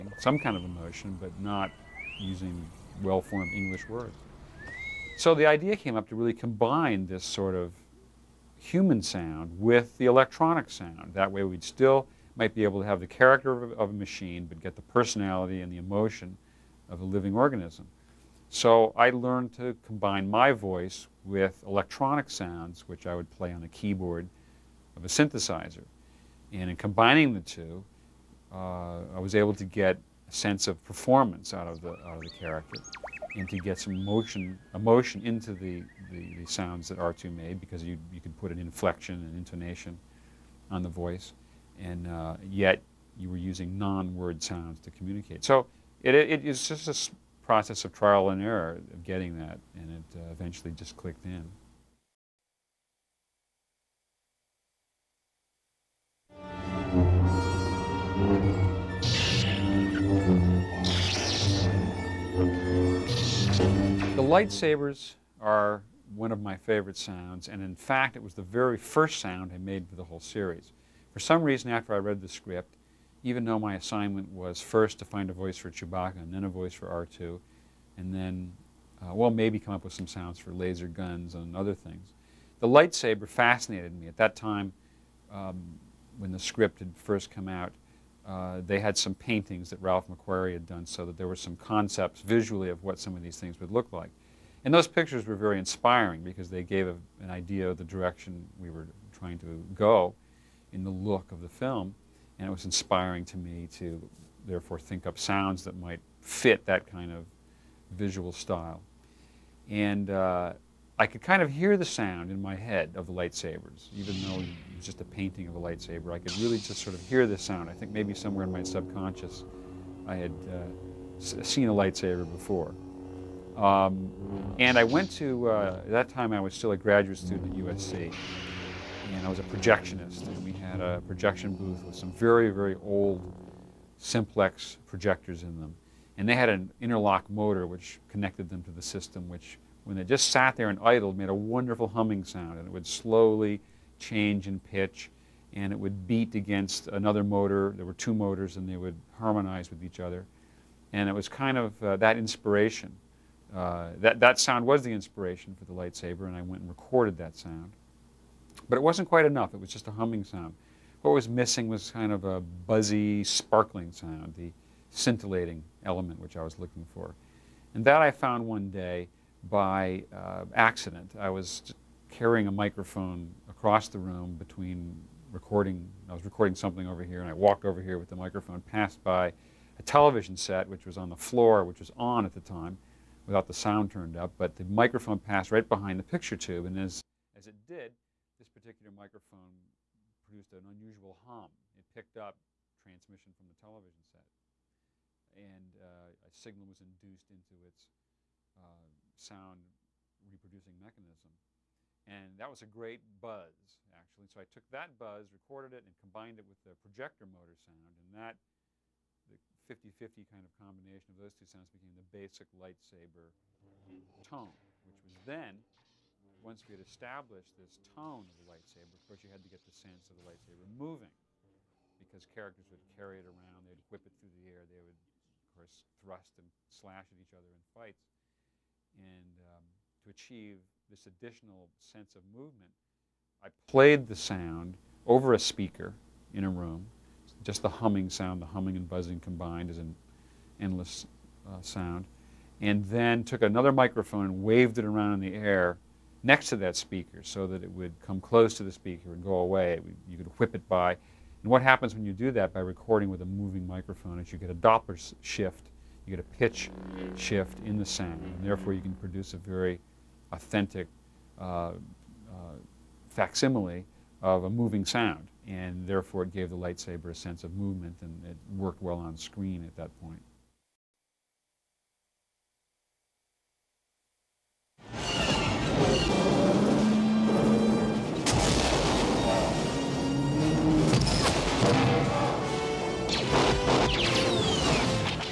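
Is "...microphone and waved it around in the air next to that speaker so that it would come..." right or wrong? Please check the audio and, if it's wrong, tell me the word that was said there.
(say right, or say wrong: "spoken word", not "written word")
right.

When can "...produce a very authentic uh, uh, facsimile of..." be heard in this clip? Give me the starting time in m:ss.
4:18.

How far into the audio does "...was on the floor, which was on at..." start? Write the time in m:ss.
3:00.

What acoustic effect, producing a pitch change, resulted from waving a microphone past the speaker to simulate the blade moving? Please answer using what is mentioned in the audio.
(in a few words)
Doppler shift.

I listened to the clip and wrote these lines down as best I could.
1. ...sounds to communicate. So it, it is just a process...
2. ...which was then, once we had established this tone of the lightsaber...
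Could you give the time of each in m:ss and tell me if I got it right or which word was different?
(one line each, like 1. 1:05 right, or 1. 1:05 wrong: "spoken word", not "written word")
1. 0:44 right
2. 3:34 right.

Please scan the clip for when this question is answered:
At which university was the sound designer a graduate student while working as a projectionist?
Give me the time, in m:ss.
2:07.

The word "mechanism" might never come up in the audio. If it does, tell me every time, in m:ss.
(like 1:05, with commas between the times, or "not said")
3:20.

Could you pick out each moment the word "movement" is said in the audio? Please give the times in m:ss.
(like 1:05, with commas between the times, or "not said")
3:52, 4:27.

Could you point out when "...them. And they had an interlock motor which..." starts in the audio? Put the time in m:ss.
2:15.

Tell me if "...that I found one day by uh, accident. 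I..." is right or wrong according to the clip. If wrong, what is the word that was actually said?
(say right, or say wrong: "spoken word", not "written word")
right.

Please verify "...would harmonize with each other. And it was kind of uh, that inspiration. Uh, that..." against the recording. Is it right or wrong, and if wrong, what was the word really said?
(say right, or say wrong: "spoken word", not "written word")
right.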